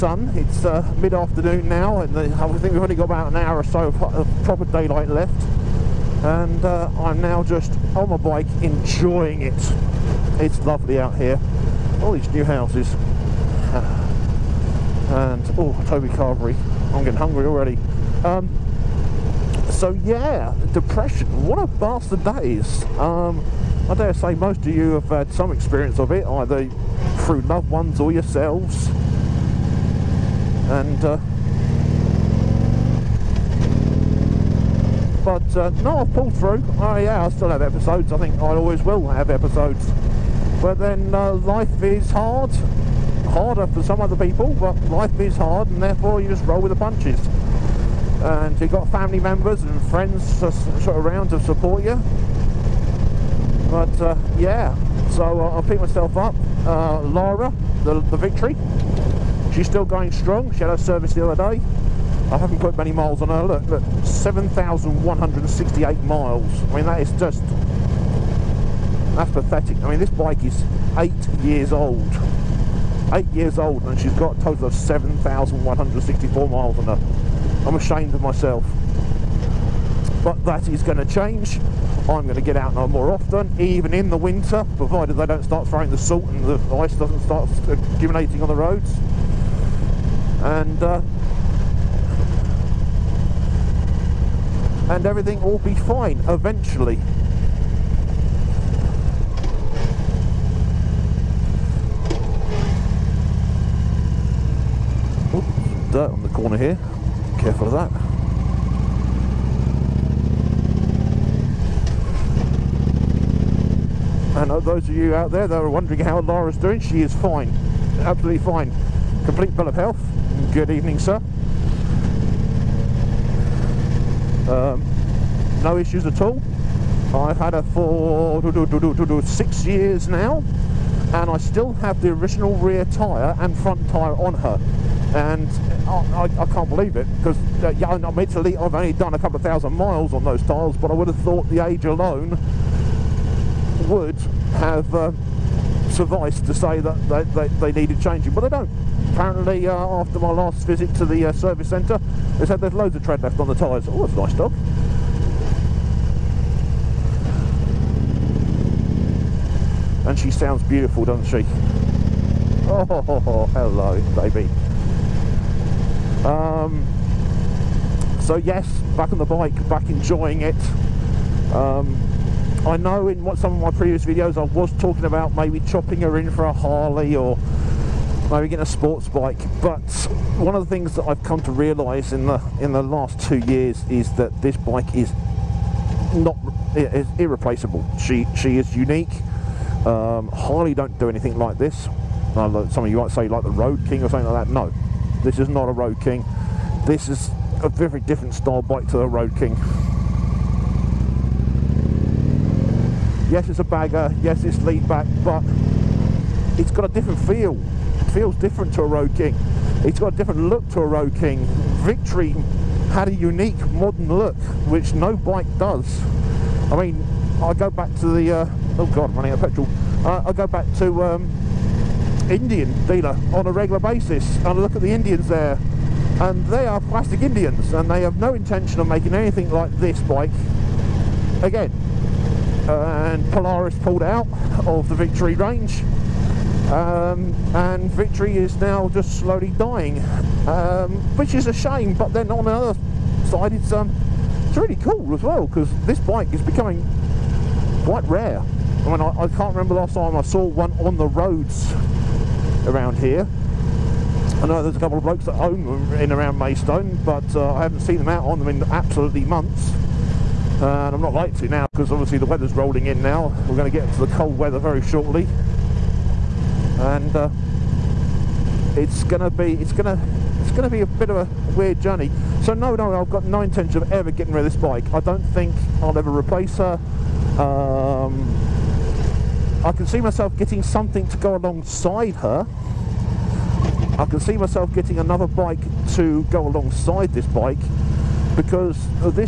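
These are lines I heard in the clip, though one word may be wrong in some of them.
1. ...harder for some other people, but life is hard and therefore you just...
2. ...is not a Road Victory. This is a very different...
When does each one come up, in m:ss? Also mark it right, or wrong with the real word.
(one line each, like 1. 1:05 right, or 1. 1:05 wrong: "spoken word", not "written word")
1. 0:43 right
2. 3:15 wrong: "King", not "Victory".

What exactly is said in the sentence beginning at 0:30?
And uh, but uh, no, I've pulled through.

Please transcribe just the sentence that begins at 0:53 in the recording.
But uh, yeah, so uh, I'll pick myself up.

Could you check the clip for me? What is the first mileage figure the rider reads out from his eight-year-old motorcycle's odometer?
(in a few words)
7,168 miles.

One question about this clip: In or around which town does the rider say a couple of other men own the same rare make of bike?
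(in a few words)
Maidstone.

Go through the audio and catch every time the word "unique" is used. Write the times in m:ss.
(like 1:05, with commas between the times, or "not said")
3:08, 3:33.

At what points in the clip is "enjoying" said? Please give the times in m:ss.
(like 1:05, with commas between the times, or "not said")
0:08, 2:49.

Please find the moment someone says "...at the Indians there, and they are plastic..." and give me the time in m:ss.
3:44.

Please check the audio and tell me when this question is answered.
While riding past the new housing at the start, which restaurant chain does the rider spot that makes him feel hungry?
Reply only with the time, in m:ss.
0:15.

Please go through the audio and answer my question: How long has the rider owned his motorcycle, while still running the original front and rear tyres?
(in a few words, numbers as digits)
6 years.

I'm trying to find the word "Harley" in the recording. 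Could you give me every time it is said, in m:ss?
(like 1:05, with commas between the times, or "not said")
2:56, 3:10.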